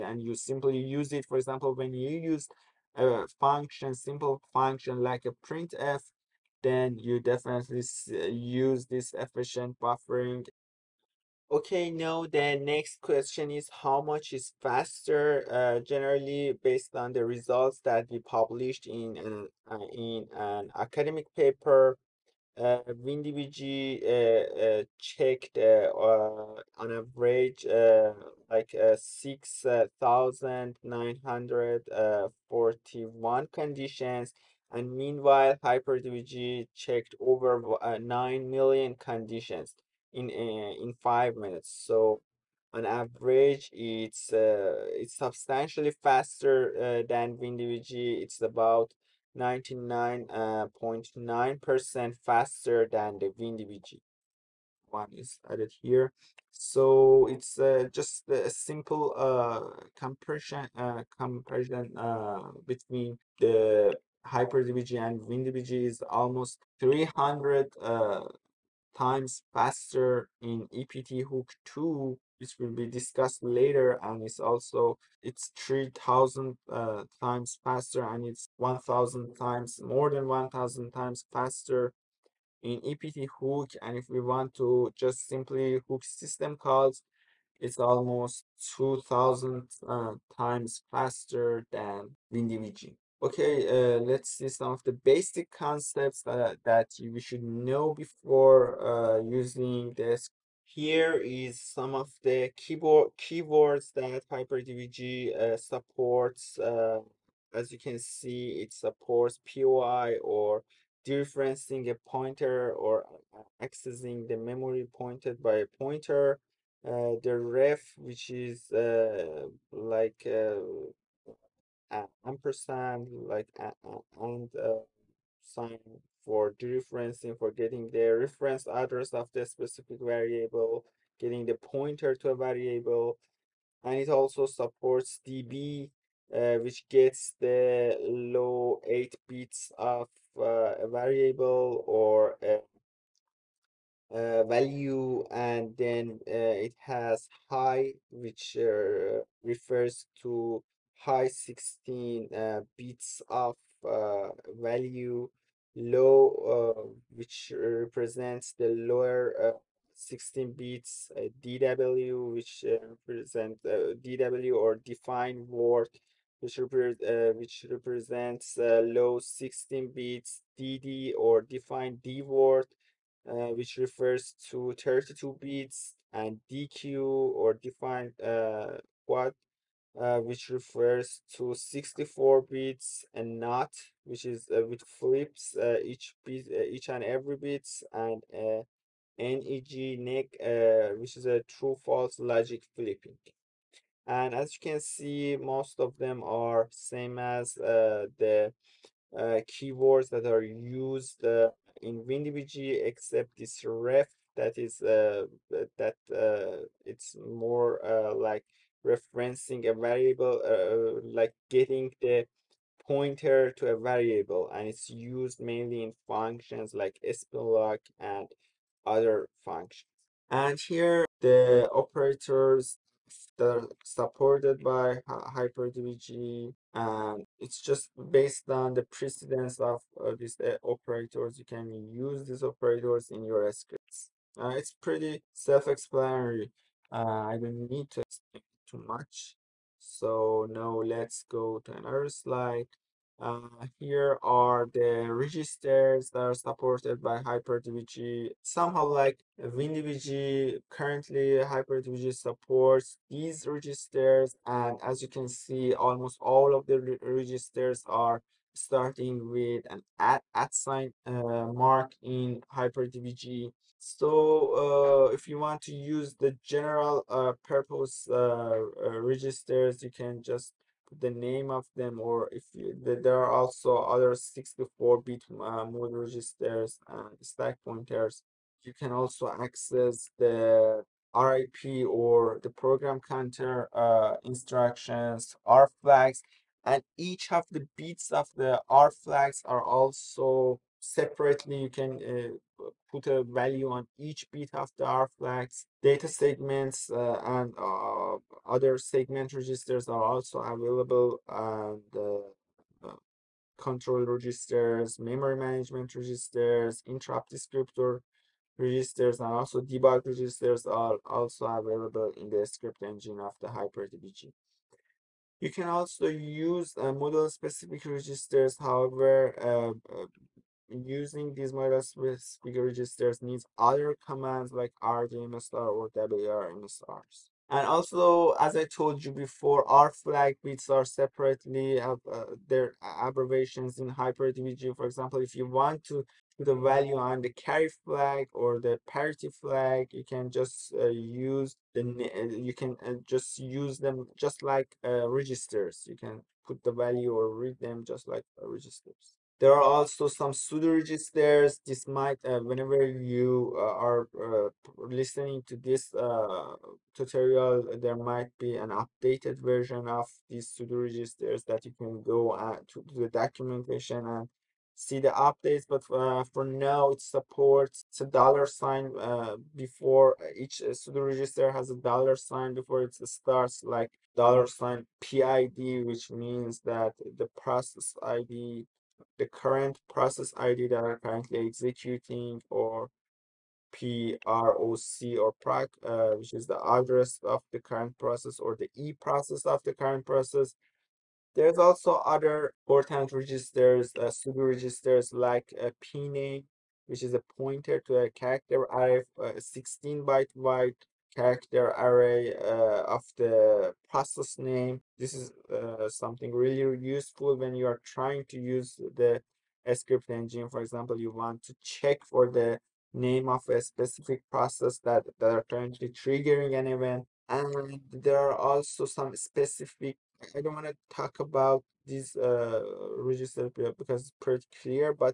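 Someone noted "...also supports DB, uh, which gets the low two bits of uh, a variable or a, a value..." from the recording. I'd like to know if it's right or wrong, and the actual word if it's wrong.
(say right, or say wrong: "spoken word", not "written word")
wrong: "eight", not "two".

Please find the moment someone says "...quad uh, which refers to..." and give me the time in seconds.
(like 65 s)
179 s.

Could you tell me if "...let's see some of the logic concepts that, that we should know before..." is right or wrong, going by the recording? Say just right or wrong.
wrong.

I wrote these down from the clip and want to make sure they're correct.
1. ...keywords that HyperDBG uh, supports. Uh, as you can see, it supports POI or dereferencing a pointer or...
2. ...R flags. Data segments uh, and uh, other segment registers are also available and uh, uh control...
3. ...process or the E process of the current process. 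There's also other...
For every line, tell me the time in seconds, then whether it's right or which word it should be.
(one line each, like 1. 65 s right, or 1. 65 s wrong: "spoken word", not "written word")
1. 103 s right
2. 294 s right
3. 387 s right.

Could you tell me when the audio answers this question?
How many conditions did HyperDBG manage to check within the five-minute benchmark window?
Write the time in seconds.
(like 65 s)
37 s.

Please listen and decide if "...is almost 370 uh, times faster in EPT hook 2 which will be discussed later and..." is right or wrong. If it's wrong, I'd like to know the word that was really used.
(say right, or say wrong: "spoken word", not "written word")
wrong: "300", not "370".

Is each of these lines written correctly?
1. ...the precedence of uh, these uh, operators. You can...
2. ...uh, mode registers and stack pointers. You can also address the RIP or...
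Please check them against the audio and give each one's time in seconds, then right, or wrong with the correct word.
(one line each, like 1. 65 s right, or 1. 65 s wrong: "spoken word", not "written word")
1. 228 s right
2. 275 s wrong: "access", not "address".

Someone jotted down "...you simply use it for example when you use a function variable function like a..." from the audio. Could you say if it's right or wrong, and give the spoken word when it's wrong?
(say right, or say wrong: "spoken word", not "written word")
wrong: "simple", not "variable".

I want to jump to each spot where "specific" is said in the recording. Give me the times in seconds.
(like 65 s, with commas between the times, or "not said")
129 s, 317 s, 413 s, 419 s.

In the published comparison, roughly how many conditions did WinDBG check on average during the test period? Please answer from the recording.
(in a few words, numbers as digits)
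6,941.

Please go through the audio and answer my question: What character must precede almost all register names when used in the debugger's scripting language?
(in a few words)
at sign.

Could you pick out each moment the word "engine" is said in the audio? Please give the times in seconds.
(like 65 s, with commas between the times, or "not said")
312 s, 410 s.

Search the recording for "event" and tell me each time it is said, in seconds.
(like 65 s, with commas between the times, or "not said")
416 s.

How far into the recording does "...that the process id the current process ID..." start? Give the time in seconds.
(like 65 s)
376 s.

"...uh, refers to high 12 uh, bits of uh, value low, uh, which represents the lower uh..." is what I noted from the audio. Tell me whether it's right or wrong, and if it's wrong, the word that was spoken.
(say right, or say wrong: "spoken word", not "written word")
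wrong: "16", not "12".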